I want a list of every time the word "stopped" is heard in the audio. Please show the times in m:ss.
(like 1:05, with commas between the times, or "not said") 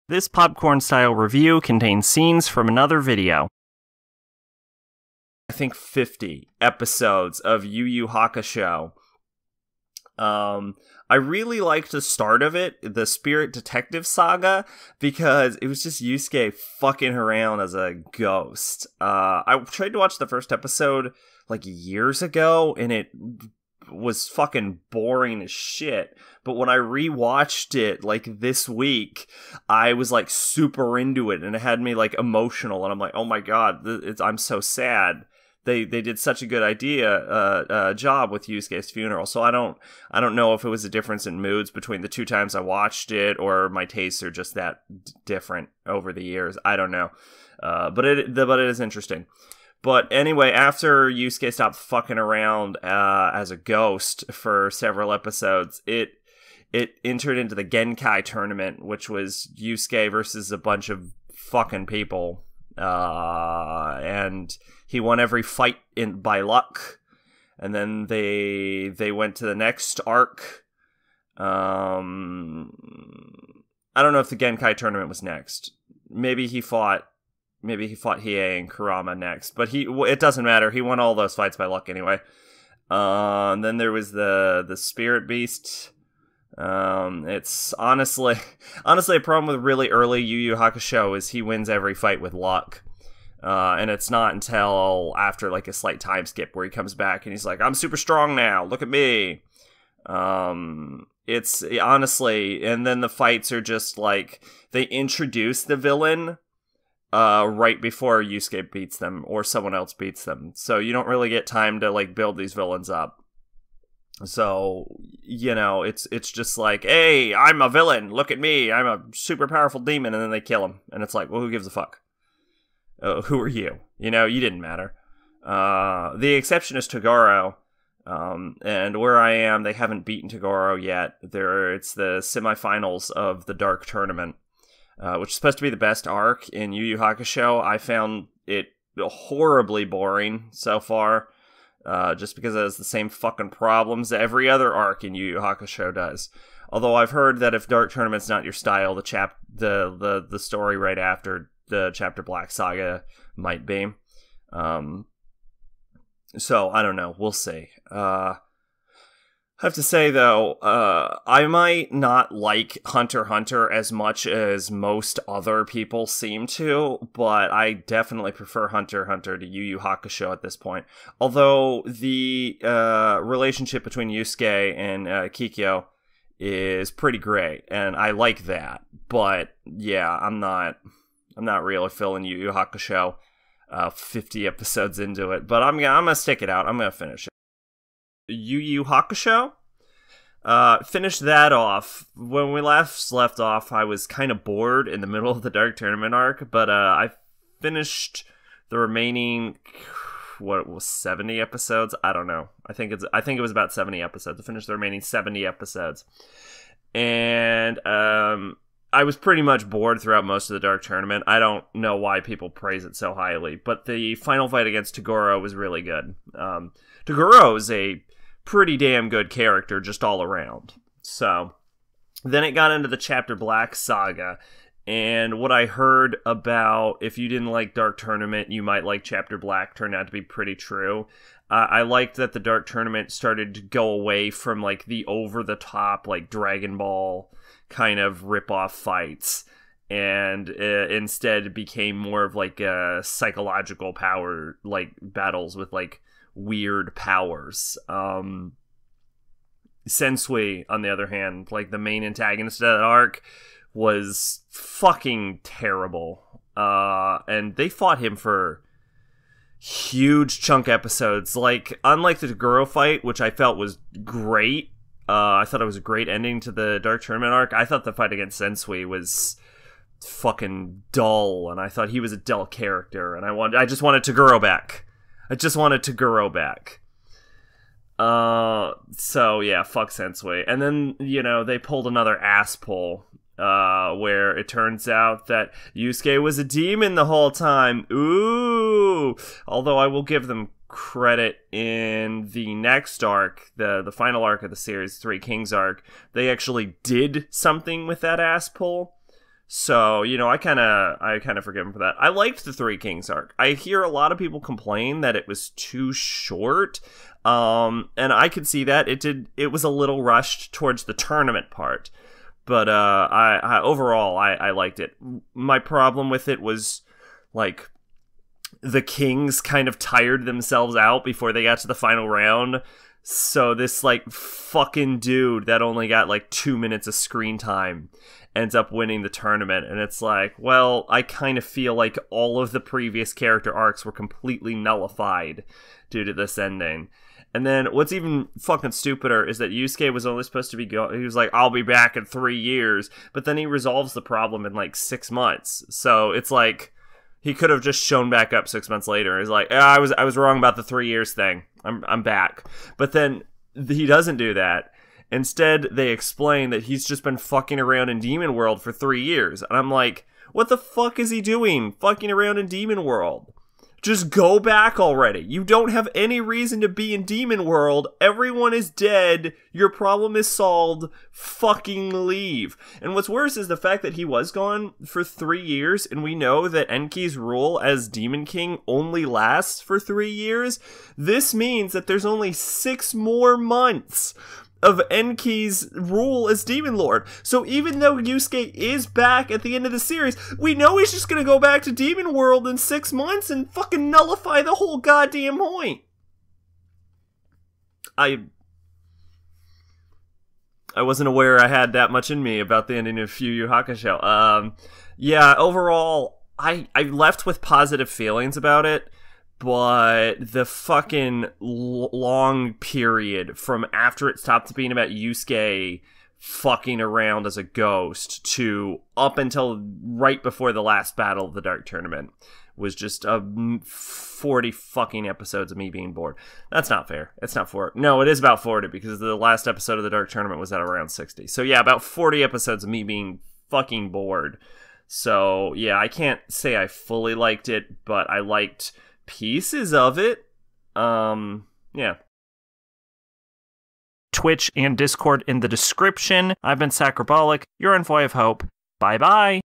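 0:51, 6:54.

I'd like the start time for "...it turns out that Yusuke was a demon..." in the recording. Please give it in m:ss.
4:44.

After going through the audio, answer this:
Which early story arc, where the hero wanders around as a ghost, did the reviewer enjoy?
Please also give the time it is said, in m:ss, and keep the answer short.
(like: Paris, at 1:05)
Spirit Detective Saga, at 0:13.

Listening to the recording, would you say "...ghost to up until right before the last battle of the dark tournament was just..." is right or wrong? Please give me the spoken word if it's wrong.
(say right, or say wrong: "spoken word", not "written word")
right.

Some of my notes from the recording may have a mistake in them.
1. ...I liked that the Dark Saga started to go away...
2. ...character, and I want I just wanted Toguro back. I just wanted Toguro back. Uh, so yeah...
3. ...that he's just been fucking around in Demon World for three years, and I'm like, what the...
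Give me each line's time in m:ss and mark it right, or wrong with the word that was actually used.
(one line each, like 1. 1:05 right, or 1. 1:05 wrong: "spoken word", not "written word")
1. 3:51 wrong: "Tournament", not "Saga"
2. 4:32 right
3. 5:56 right.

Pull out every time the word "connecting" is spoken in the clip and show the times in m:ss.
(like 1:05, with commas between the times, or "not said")
not said.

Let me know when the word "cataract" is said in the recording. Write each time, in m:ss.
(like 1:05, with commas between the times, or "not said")
not said.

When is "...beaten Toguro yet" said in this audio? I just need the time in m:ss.
2:10.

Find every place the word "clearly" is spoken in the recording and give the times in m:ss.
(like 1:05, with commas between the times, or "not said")
not said.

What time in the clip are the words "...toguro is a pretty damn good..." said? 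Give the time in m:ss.
3:37.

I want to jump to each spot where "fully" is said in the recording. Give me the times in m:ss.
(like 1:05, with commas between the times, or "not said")
7:16.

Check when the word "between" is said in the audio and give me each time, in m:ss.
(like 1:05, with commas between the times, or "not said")
0:41, 2:53.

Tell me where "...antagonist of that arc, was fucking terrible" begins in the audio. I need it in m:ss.
4:12.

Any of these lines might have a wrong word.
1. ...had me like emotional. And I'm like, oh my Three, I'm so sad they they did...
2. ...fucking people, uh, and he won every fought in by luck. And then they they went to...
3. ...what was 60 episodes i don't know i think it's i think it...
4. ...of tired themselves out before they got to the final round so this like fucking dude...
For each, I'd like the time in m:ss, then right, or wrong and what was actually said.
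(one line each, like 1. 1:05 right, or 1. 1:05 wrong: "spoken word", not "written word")
1. 0:31 wrong: "God", not "Three"
2. 1:01 wrong: "fight", not "fought"
3. 3:20 wrong: "70", not "60"
4. 5:19 right.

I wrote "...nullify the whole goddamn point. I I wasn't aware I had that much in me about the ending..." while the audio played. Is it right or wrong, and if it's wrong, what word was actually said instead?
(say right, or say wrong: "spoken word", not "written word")
right.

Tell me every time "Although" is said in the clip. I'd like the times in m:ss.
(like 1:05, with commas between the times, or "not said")
2:26, 2:51, 4:49.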